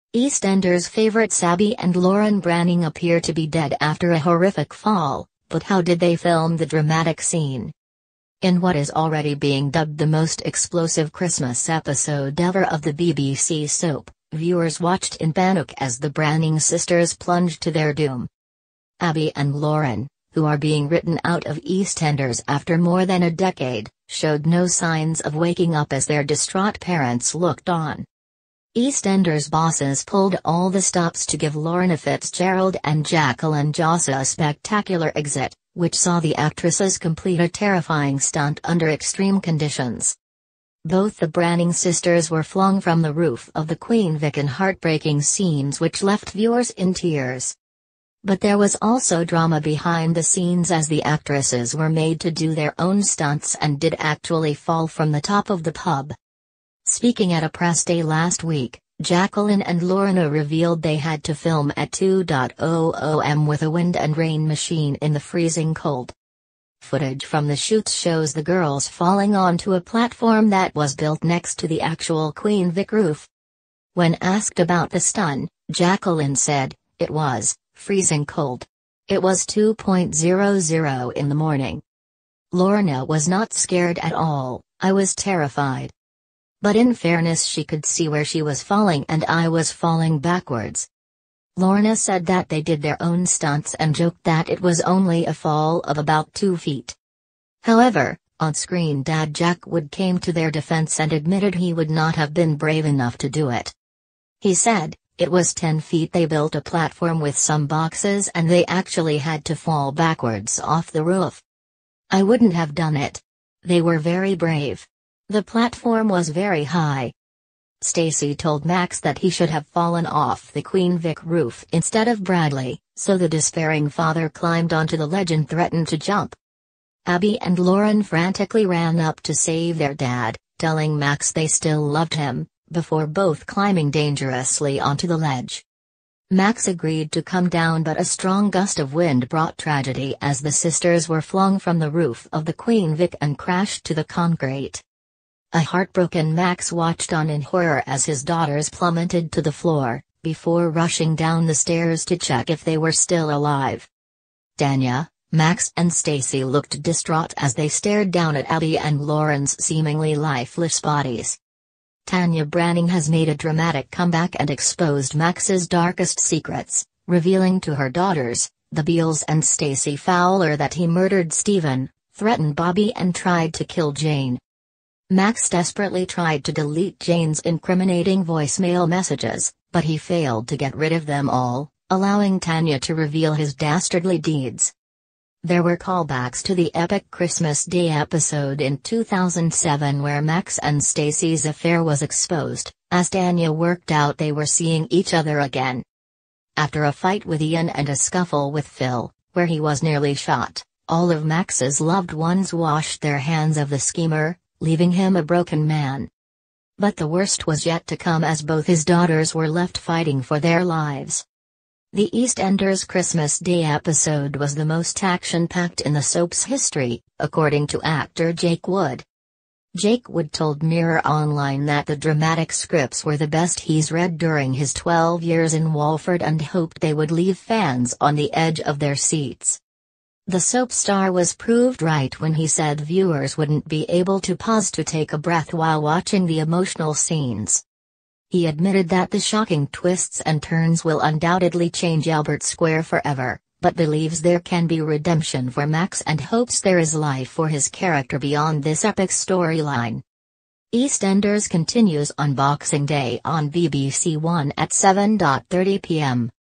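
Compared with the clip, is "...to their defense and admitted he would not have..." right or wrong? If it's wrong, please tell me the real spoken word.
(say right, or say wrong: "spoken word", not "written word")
right.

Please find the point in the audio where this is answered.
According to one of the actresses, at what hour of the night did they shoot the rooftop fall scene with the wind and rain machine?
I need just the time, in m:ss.
1:19.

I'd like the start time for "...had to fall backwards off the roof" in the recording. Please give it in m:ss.
1:49.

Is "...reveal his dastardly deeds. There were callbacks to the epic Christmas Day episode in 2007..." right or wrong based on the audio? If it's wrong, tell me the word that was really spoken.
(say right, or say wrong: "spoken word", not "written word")
right.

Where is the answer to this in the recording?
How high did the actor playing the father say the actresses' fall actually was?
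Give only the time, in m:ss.
1:45.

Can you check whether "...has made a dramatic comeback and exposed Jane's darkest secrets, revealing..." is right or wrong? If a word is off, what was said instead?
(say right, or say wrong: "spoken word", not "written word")
wrong: "Max", not "Jane".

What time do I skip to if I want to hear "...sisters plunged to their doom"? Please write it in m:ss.
0:16.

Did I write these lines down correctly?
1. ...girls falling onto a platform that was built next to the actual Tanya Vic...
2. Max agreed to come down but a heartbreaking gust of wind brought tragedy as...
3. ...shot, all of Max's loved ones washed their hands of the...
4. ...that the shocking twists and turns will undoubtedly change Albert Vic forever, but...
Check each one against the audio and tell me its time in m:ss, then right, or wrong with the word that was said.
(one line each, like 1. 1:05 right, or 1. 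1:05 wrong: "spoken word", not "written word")
1. 1:08 wrong: "Queen", not "Tanya"
2. 2:16 wrong: "strong", not "heartbreaking"
3. 3:20 right
4. 3:58 wrong: "Square", not "Vic".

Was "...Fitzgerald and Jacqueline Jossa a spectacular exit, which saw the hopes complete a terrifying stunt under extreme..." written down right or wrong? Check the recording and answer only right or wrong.
wrong.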